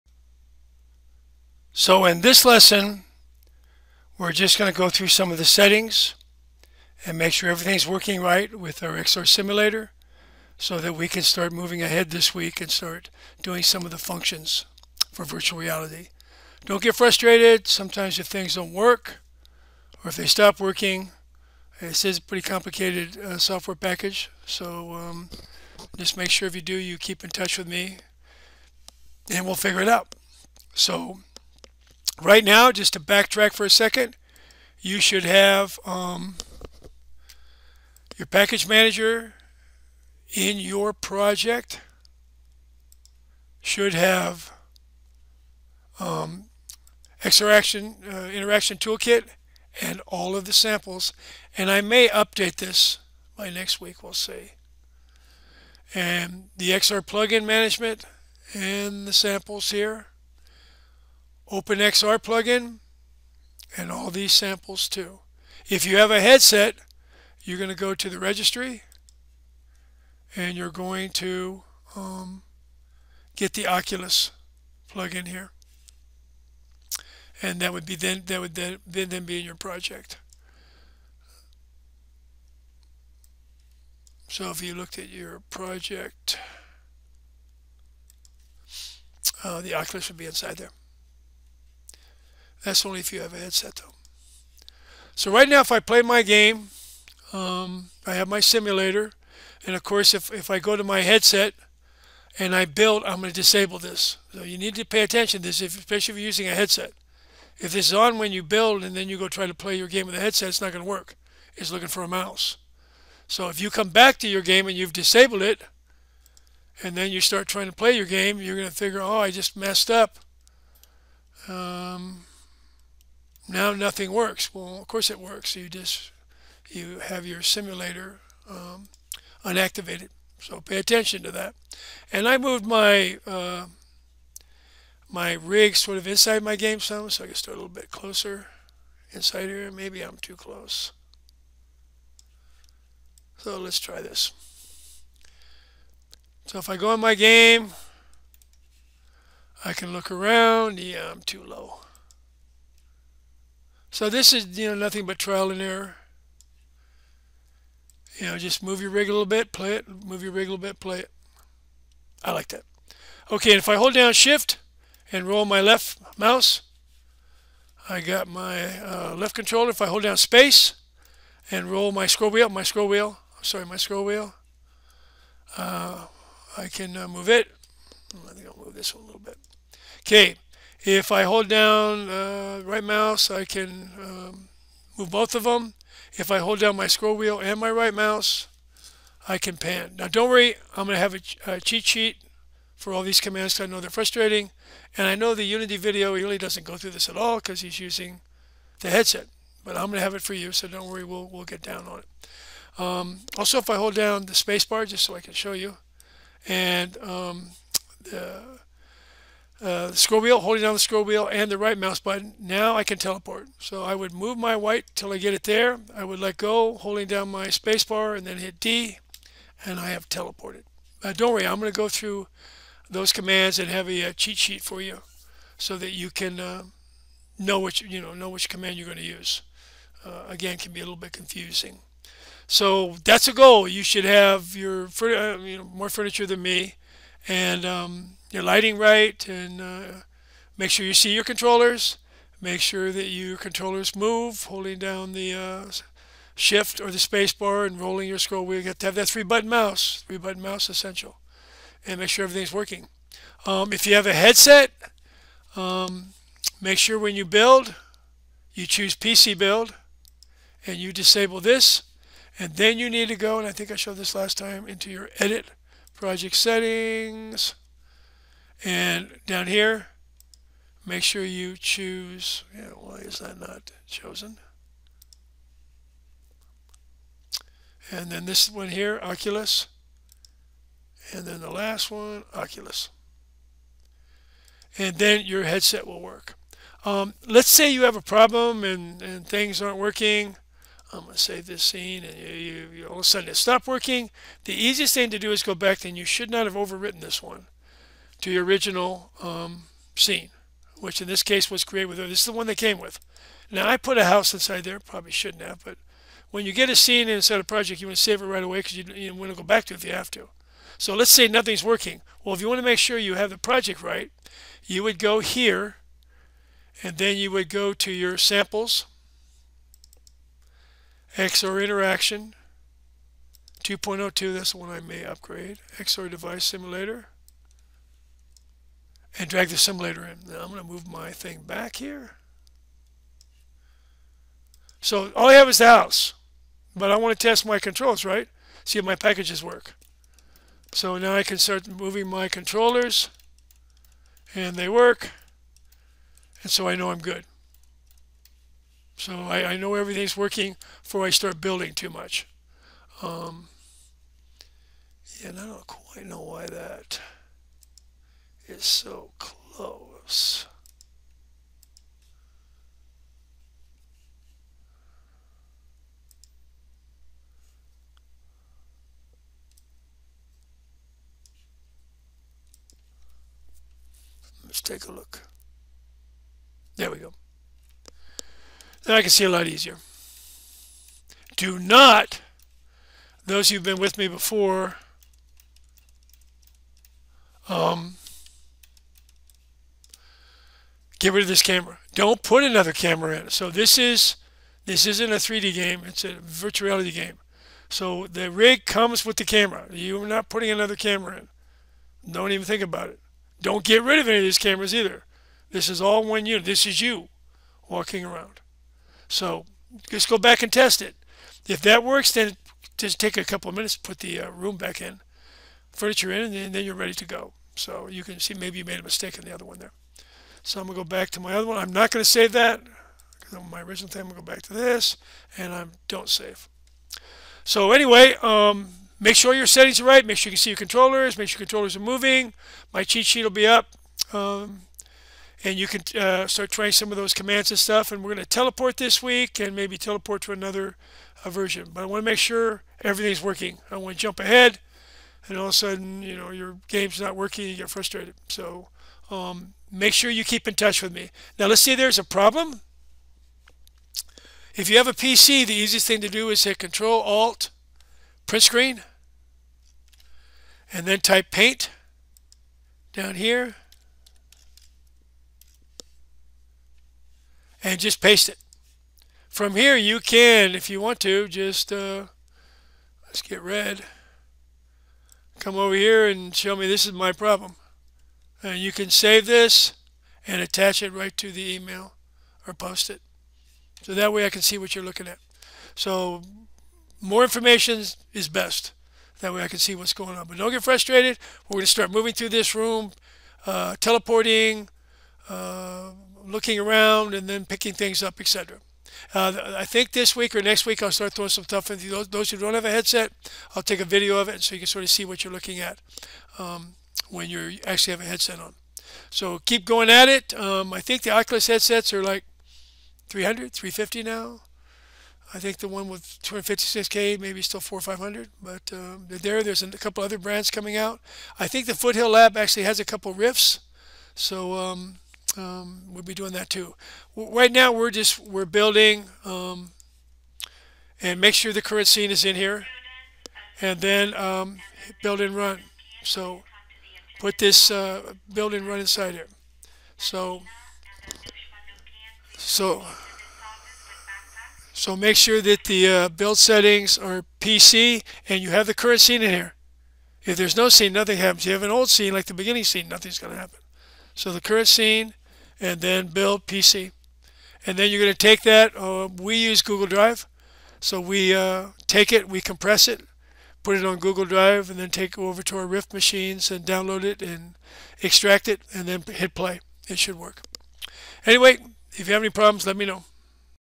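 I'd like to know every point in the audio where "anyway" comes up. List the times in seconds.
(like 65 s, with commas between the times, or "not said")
427 s, 571 s.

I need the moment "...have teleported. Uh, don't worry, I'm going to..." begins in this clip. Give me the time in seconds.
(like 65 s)
219 s.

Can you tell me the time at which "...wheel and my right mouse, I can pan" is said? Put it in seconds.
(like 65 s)
187 s.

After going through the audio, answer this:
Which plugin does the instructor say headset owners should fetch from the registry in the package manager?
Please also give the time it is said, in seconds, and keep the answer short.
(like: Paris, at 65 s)
Oculus plugin, at 73 s.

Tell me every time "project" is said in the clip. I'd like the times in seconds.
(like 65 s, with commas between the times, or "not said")
40 s, 79 s, 85 s, 266 s, 307 s, 313 s.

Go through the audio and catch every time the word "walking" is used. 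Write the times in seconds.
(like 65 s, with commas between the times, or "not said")
407 s.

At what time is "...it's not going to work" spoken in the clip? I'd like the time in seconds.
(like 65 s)
110 s.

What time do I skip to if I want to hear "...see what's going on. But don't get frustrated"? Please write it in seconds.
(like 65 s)
489 s.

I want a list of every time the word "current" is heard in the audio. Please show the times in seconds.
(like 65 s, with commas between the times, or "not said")
531 s, 548 s, 554 s.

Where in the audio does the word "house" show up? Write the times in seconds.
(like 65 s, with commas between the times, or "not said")
304 s, 335 s.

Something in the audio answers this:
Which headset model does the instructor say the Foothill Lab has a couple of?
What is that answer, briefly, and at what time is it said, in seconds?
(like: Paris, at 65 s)
Rifts, at 523 s.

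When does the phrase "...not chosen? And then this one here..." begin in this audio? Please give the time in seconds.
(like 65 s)
273 s.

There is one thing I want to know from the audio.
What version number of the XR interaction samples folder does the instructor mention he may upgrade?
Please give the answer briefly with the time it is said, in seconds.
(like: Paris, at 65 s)
2.02, at 323 s.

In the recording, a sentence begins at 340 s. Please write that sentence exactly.
So now I can start moving my controllers.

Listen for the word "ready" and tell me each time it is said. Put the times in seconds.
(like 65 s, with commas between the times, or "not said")
416 s.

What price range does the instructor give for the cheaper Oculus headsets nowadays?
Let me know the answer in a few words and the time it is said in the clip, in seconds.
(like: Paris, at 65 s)
300 to 350, at 513 s.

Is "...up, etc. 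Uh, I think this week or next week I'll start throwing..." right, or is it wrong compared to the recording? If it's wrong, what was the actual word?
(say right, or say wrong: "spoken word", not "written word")
right.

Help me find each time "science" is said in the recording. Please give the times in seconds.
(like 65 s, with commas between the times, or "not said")
not said.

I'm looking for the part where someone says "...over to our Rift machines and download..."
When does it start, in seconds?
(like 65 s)
565 s.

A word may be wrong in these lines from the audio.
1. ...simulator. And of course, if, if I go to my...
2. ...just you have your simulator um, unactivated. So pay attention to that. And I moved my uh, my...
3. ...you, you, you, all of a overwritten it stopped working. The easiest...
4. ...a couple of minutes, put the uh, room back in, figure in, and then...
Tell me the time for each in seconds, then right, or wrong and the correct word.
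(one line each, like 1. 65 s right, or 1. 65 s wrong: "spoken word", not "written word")
1. 98 s right
2. 125 s right
3. 292 s wrong: "sudden", not "overwritten"
4. 413 s wrong: "furniture", not "figure".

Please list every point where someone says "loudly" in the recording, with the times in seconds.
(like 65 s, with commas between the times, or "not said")
not said.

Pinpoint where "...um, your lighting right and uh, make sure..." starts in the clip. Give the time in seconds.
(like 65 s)
237 s.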